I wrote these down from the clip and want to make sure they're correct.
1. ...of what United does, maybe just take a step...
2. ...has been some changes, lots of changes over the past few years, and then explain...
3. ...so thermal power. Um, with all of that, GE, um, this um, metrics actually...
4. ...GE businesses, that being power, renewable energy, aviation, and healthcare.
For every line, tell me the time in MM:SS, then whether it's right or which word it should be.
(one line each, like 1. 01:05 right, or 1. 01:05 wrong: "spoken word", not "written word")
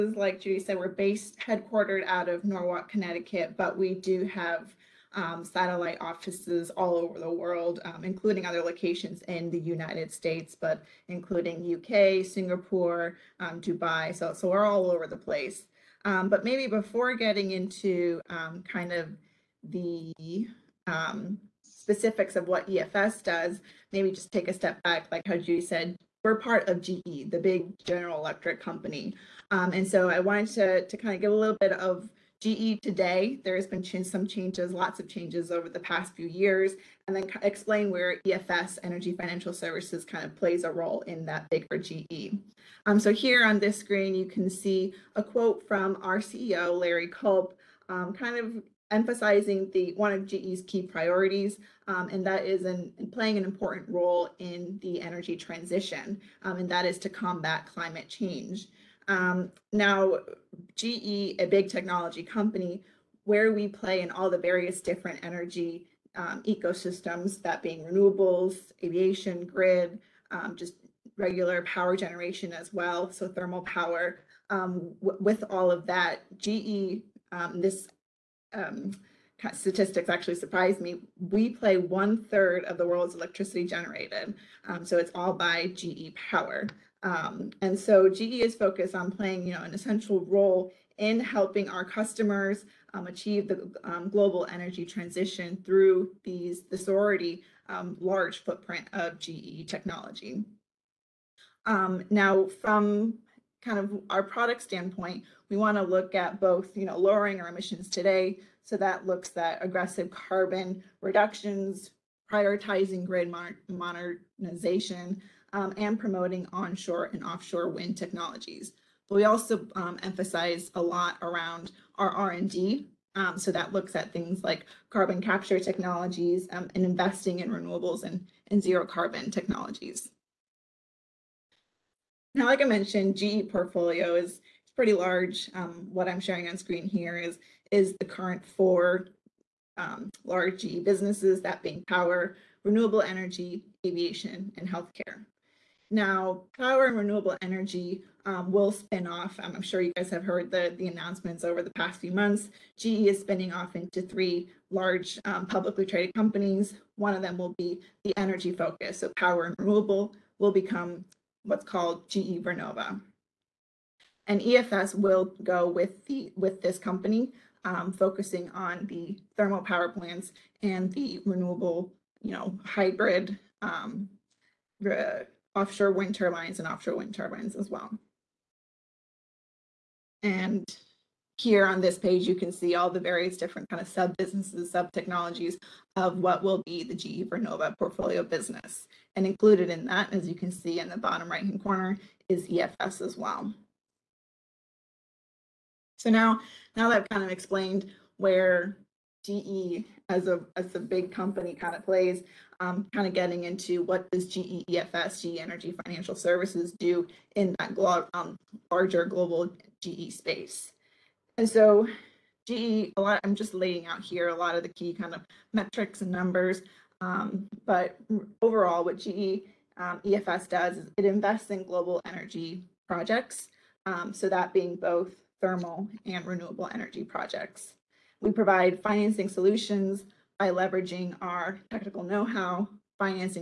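1. 00:22 wrong: "EFS", not "United"
2. 00:33 right
3. 01:13 wrong: "statistics", not "metrics"
4. 02:20 right.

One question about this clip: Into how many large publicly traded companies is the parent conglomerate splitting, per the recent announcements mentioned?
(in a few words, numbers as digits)
3.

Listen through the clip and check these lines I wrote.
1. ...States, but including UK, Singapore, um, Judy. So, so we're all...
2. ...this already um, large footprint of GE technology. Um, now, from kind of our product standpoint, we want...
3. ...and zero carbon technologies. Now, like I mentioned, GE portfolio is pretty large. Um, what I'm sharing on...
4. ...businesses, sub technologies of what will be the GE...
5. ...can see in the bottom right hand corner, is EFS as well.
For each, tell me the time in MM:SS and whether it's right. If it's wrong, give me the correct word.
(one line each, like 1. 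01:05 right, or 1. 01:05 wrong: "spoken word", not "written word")
1. 00:10 wrong: "Dubai", not "Judy"
2. 01:36 right
3. 02:08 right
4. 03:04 right
5. 03:10 right.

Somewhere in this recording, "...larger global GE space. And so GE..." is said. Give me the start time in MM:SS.
03:28.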